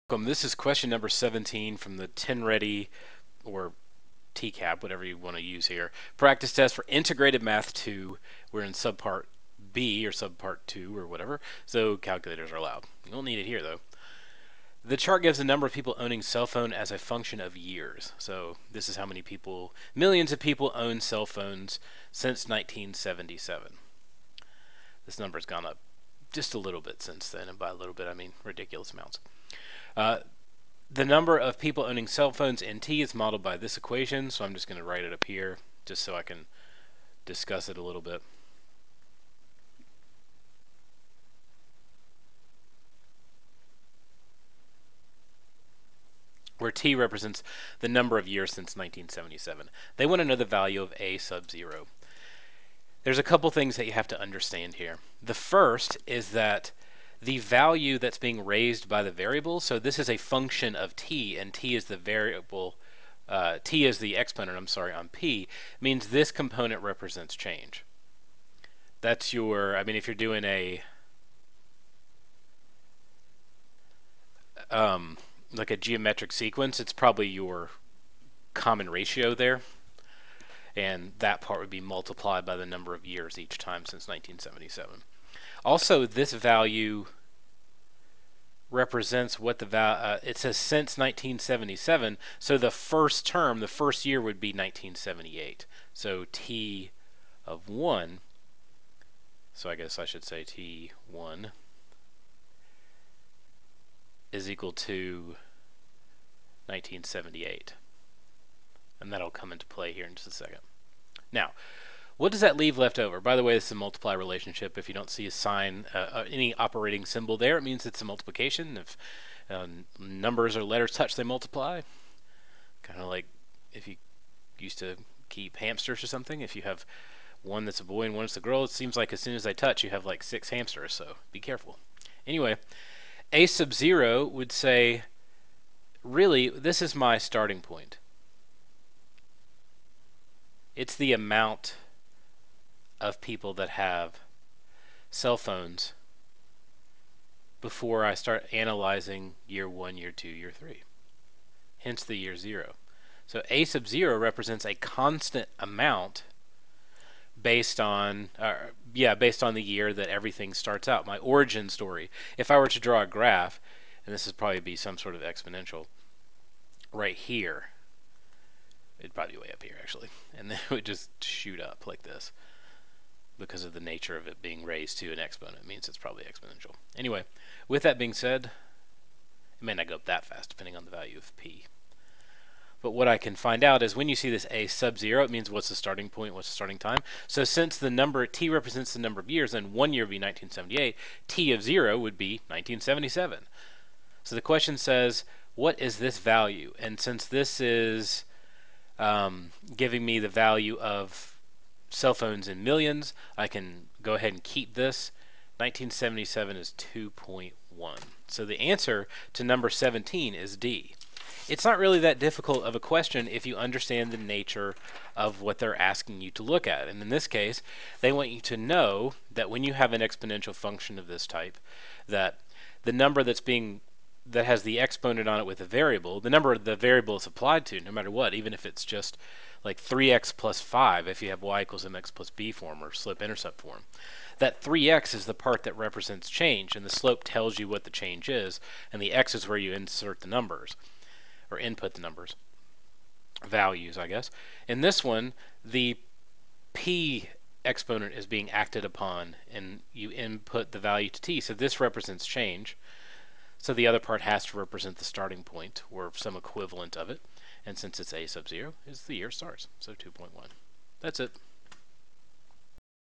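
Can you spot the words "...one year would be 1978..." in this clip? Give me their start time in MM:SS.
03:09.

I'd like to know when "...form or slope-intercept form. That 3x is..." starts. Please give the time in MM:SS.
03:52.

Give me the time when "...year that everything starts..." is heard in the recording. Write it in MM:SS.
02:39.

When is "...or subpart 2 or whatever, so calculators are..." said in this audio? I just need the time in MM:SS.
00:10.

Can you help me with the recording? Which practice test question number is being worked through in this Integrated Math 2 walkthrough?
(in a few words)
17.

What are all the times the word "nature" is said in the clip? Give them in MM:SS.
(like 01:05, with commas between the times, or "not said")
02:53, 03:34.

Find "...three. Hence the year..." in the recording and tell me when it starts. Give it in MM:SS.
02:30.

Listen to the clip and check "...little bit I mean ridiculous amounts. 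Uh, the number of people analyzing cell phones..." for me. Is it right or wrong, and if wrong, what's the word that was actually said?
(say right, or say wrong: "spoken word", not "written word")
wrong: "owning", not "analyzing".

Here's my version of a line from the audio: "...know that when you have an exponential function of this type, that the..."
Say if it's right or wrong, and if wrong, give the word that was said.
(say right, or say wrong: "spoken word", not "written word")
right.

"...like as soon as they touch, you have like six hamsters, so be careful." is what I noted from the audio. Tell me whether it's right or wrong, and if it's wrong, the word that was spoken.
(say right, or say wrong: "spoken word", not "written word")
right.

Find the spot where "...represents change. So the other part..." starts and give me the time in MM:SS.
04:11.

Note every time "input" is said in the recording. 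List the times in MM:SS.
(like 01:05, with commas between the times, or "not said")
04:01, 04:10.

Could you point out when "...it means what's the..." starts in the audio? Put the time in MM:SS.
03:05.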